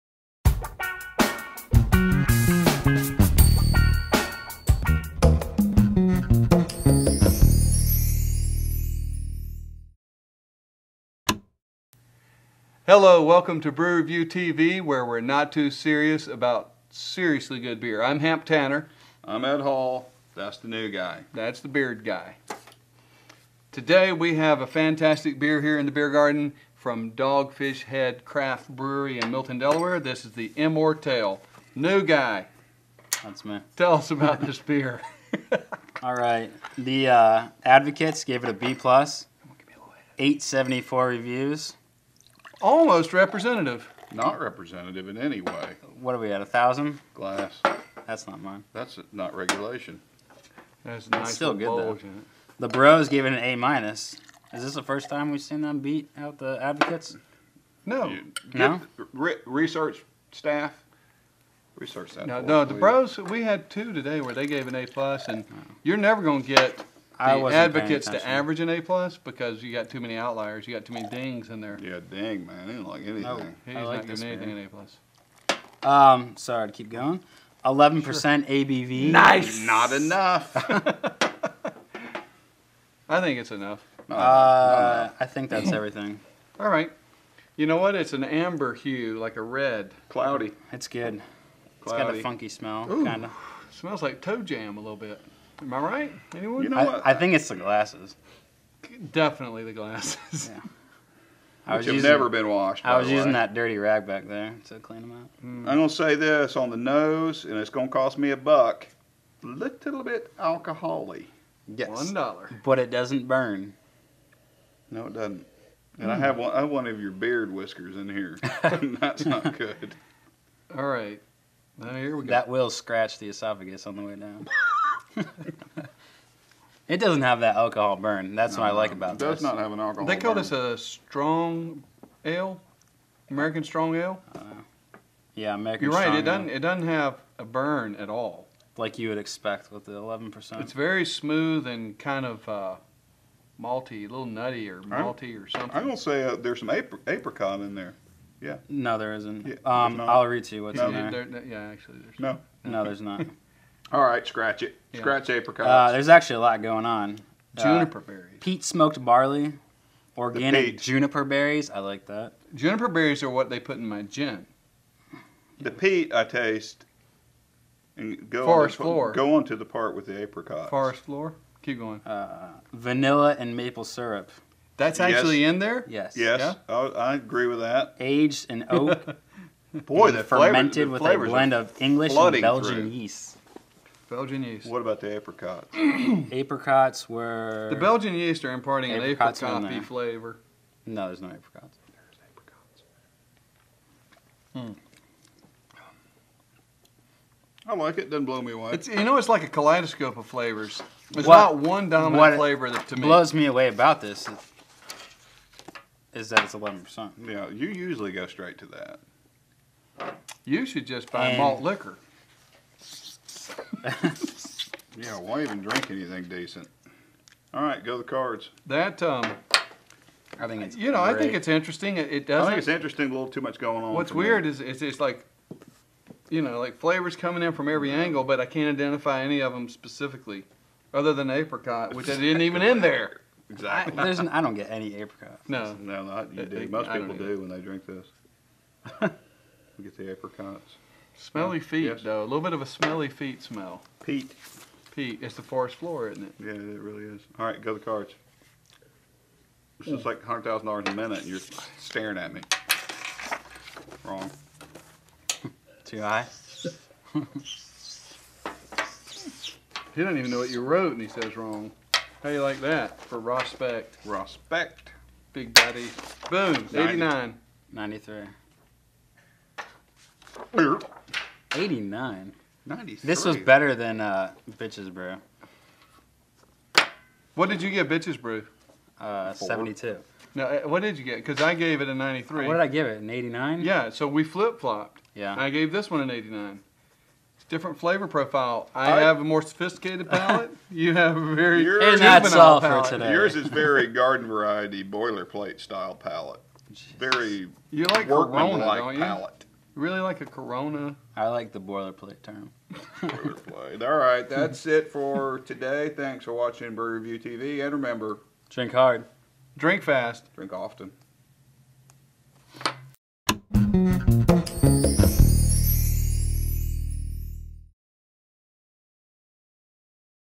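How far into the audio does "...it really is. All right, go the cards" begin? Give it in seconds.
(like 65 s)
246 s.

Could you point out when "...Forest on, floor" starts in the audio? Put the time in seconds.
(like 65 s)
168 s.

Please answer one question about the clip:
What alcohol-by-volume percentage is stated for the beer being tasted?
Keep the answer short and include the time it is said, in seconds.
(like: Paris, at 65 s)
11%, at 77 s.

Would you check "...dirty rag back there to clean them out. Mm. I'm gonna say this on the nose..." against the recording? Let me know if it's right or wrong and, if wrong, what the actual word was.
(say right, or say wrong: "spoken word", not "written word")
right.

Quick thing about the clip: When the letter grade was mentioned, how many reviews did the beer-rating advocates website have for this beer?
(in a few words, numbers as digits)
874.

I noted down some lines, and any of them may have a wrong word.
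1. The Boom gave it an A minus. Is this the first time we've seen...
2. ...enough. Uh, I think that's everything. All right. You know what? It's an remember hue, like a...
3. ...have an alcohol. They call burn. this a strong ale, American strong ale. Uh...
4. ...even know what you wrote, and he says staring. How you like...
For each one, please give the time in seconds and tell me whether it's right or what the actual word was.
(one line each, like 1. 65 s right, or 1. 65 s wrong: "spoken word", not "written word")
1. 52 s wrong: "Bros", not "Boom"
2. 83 s wrong: "amber", not "remember"
3. 129 s right
4. 260 s wrong: "wrong", not "staring".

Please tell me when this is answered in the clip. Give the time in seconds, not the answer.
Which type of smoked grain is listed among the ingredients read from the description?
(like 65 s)
158 s.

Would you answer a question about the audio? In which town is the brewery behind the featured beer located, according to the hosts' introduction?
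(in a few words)
Milton, Delaware.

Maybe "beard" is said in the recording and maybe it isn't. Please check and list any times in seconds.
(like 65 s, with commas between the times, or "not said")
21 s, 117 s.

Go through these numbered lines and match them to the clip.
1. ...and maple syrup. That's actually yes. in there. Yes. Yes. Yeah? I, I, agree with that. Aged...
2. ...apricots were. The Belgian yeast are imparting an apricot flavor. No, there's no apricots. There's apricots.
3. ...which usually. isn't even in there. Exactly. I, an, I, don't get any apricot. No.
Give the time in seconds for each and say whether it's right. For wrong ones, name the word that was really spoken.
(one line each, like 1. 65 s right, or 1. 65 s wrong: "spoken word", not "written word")
1. 173 s right
2. 186 s right
3. 231 s wrong: "exactly", not "usually".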